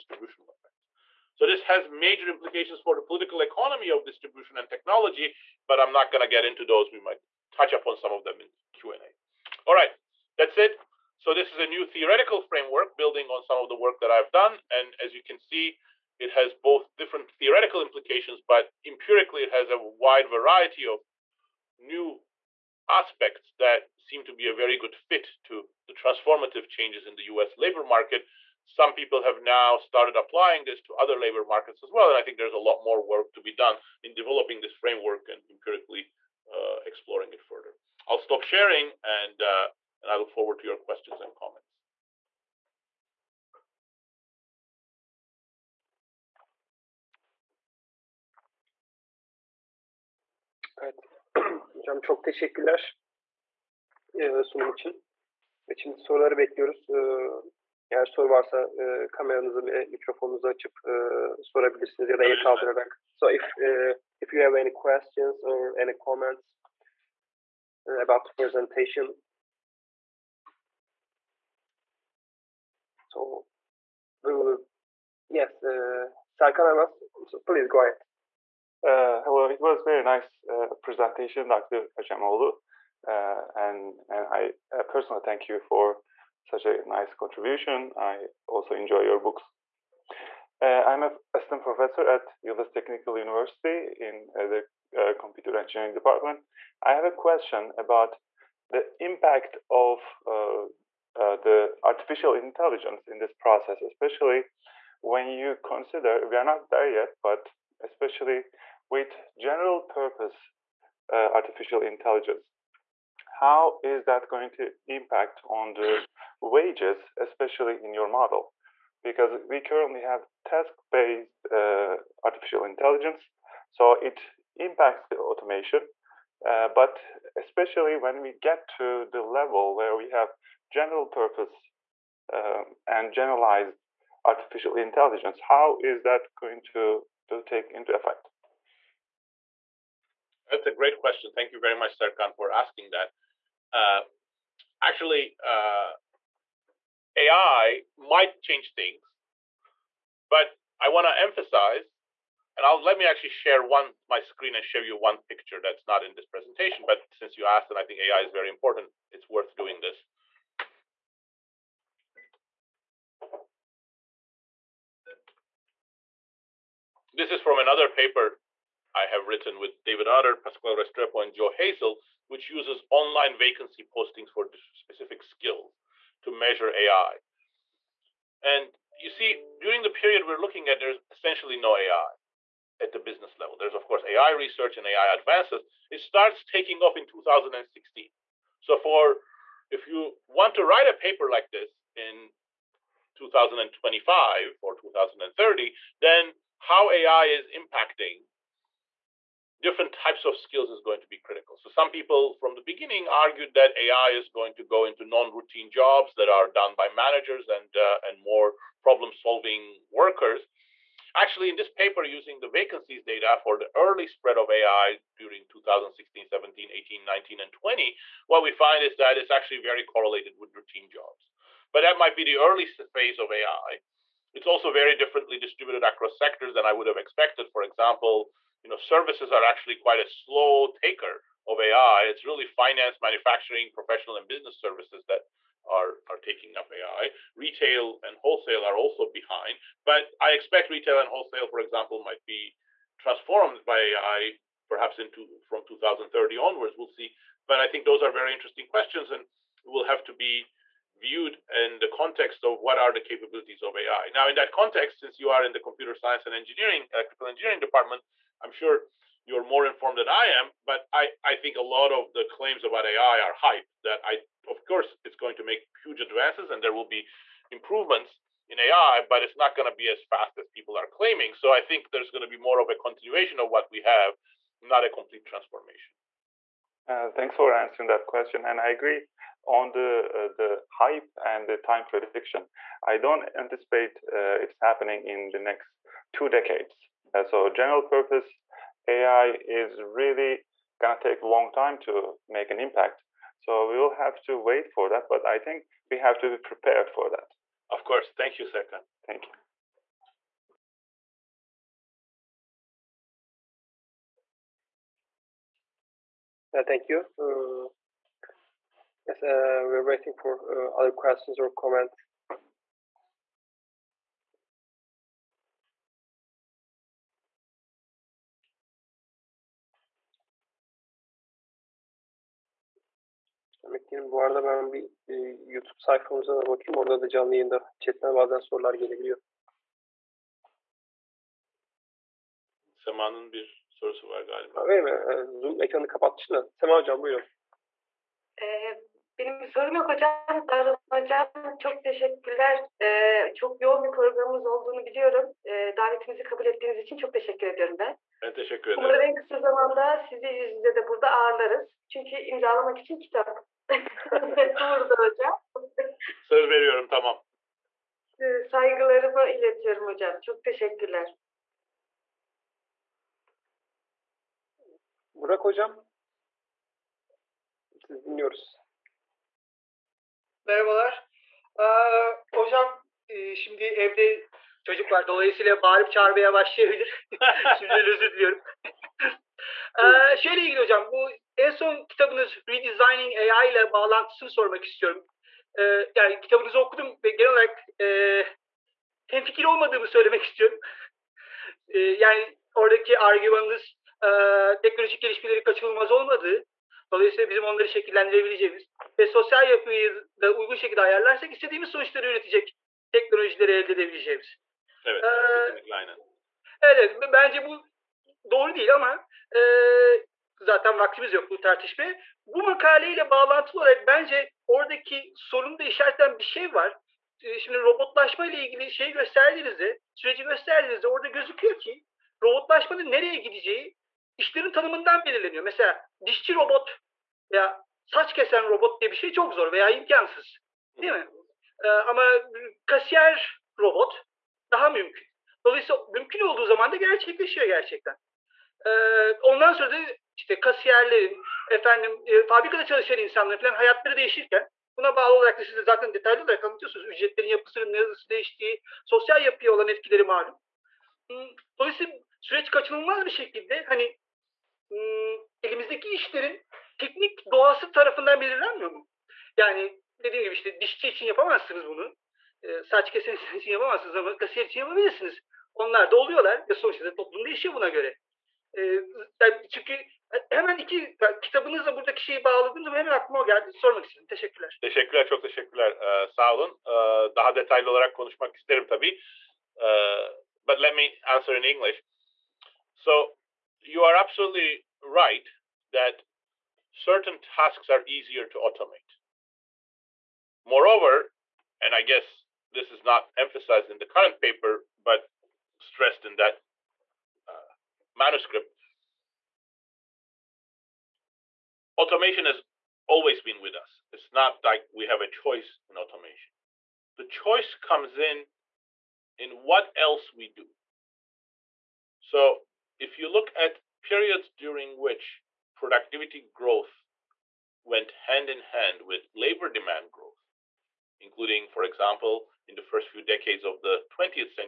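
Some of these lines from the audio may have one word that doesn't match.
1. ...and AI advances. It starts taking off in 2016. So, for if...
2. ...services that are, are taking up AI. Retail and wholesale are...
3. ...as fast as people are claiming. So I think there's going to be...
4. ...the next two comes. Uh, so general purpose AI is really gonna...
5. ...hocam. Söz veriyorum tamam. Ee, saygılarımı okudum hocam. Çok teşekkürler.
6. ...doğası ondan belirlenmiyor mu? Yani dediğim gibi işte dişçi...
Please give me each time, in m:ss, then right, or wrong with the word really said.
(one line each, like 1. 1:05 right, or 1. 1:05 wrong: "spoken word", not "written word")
1. 3:04 right
2. 3:54 right
3. 4:29 right
4. 4:45 wrong: "decades", not "comes"
5. 5:54 wrong: "iletiyorum", not "okudum"
6. 7:37 wrong: "tarafından", not "ondan".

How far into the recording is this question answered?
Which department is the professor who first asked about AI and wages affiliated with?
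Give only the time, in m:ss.
1:35.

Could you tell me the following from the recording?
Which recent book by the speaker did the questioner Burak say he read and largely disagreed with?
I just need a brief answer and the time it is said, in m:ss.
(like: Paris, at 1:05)
Redesigning AI, at 6:22.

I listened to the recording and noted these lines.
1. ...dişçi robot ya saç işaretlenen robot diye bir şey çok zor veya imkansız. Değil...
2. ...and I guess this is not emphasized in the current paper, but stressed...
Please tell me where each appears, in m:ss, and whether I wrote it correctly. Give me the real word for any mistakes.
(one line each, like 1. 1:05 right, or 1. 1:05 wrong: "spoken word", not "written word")
1. 7:06 wrong: "kesen", not "işaretlenen"
2. 8:11 right.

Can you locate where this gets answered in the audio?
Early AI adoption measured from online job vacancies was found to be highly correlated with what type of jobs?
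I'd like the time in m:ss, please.
3:40.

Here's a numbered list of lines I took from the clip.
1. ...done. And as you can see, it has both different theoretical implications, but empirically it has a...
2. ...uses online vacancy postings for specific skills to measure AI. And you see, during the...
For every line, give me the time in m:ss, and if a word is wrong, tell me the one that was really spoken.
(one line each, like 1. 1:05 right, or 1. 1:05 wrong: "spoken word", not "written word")
1. 0:14 right
2. 2:52 right.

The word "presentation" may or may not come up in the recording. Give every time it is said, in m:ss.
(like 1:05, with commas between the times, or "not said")
1:08, 1:20, 2:36.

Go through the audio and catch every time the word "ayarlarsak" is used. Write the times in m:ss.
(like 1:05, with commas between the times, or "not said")
6:40.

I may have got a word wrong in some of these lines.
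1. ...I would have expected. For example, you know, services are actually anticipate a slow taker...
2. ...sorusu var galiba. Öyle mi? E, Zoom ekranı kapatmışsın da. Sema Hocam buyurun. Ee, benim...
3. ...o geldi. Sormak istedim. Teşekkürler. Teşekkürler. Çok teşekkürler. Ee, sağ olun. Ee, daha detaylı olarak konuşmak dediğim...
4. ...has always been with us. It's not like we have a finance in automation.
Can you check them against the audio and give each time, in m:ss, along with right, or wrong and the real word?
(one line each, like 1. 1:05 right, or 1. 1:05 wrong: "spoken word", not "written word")
1. 3:46 wrong: "quite", not "anticipate"
2. 5:33 right
3. 7:53 wrong: "isterim", not "dediğim"
4. 8:22 wrong: "choice", not "finance".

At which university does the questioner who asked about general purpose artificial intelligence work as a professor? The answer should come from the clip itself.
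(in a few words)
Yildiz Technical University.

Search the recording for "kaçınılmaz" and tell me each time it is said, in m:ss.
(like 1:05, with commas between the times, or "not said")
6:35, 7:32.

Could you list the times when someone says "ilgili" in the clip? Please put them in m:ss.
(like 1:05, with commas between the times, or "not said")
6:20, 6:58.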